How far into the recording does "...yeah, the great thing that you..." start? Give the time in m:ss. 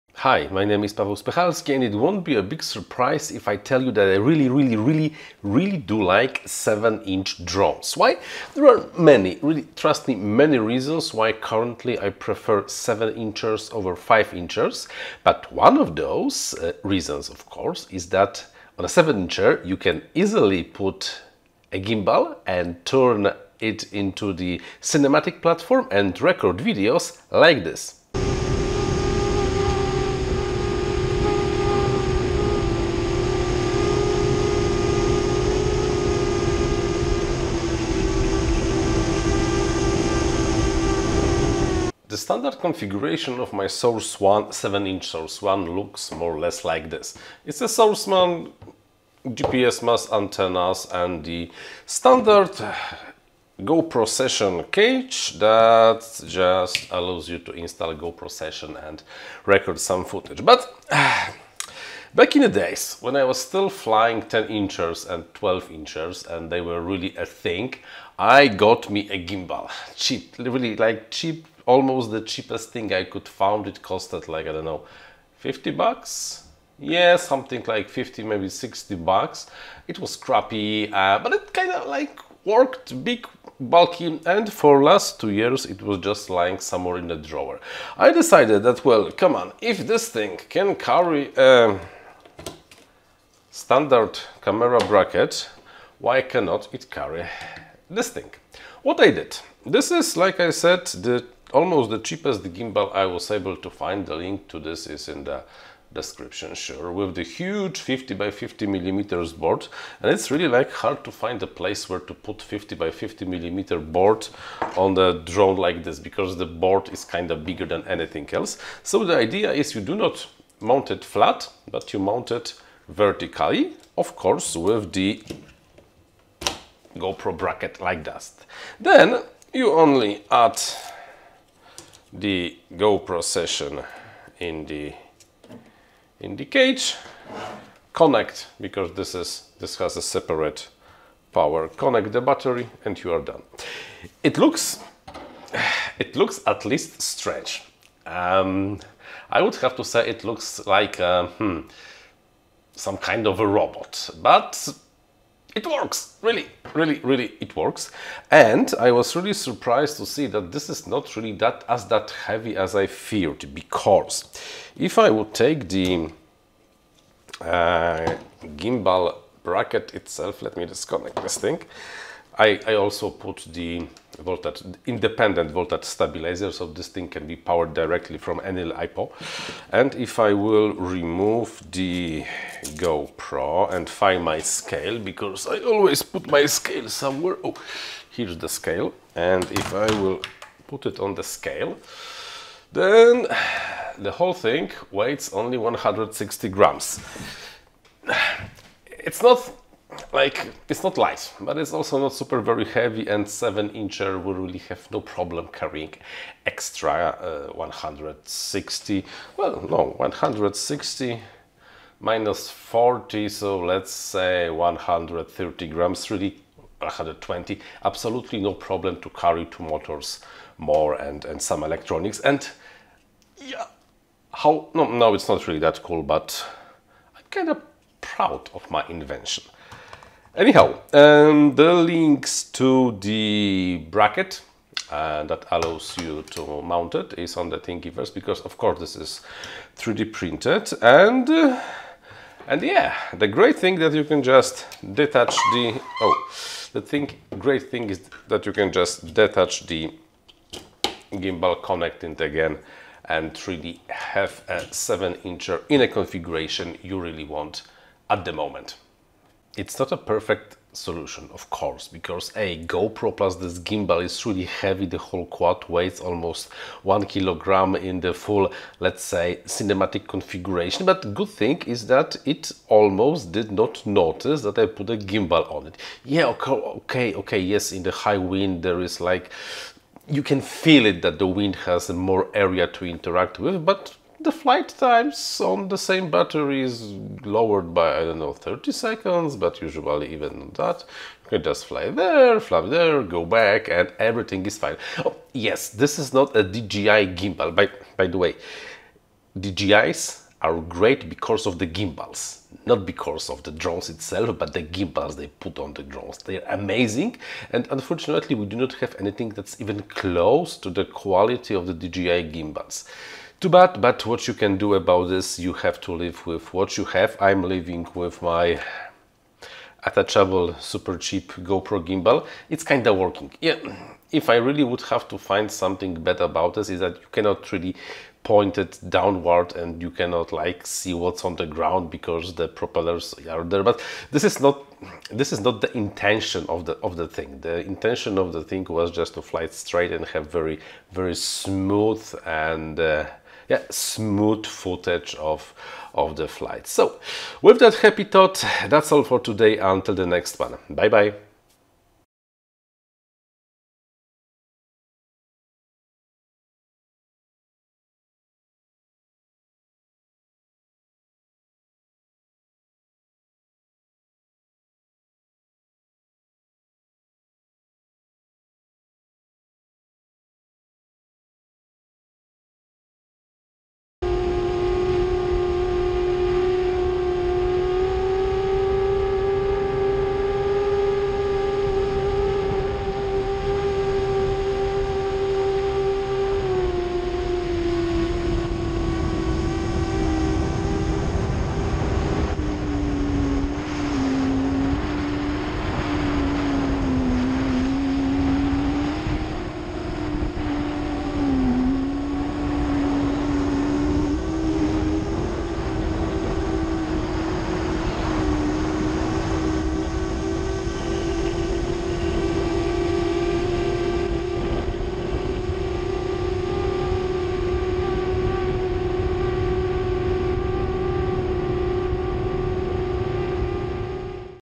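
4:02.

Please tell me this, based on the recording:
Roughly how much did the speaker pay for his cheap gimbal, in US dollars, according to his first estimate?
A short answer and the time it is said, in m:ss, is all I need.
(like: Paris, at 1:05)
50, at 1:15.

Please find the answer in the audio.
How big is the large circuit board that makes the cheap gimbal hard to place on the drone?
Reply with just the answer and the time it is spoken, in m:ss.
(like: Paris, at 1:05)
50 by 50 millimeters, at 1:47.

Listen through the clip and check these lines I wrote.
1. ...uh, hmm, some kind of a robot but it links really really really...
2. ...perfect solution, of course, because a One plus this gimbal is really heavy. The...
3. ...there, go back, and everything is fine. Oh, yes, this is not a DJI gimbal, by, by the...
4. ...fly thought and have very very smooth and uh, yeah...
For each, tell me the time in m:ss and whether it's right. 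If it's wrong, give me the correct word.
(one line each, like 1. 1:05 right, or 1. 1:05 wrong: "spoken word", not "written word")
1. 2:31 wrong: "works", not "links"
2. 4:19 wrong: "GoPro", not "One"
3. 4:52 right
4. 5:39 wrong: "straight", not "thought".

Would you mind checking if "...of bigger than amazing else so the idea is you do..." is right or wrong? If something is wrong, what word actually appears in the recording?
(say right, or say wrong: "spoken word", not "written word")
wrong: "anything", not "amazing".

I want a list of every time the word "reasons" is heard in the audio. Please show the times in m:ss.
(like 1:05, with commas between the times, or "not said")
0:10, 0:16.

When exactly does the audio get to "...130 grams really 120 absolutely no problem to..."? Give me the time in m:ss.
3:34.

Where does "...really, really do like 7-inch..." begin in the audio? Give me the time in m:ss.
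0:04.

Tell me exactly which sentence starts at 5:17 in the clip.
I'm living with my attachable, super cheap GoPro gimbal.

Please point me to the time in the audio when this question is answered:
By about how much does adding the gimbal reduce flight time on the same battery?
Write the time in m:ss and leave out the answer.
4:48.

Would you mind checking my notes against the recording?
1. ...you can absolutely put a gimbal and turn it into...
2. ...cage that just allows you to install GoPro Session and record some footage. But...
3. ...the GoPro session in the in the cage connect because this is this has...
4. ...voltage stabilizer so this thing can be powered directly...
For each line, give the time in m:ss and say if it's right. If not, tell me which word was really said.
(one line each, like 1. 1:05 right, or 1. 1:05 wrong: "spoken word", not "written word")
1. 0:19 wrong: "easily", not "absolutely"
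2. 0:54 right
3. 2:12 right
4. 2:55 right.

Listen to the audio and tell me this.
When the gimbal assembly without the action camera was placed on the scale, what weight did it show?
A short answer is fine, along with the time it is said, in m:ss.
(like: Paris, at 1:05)
160 grams, at 3:15.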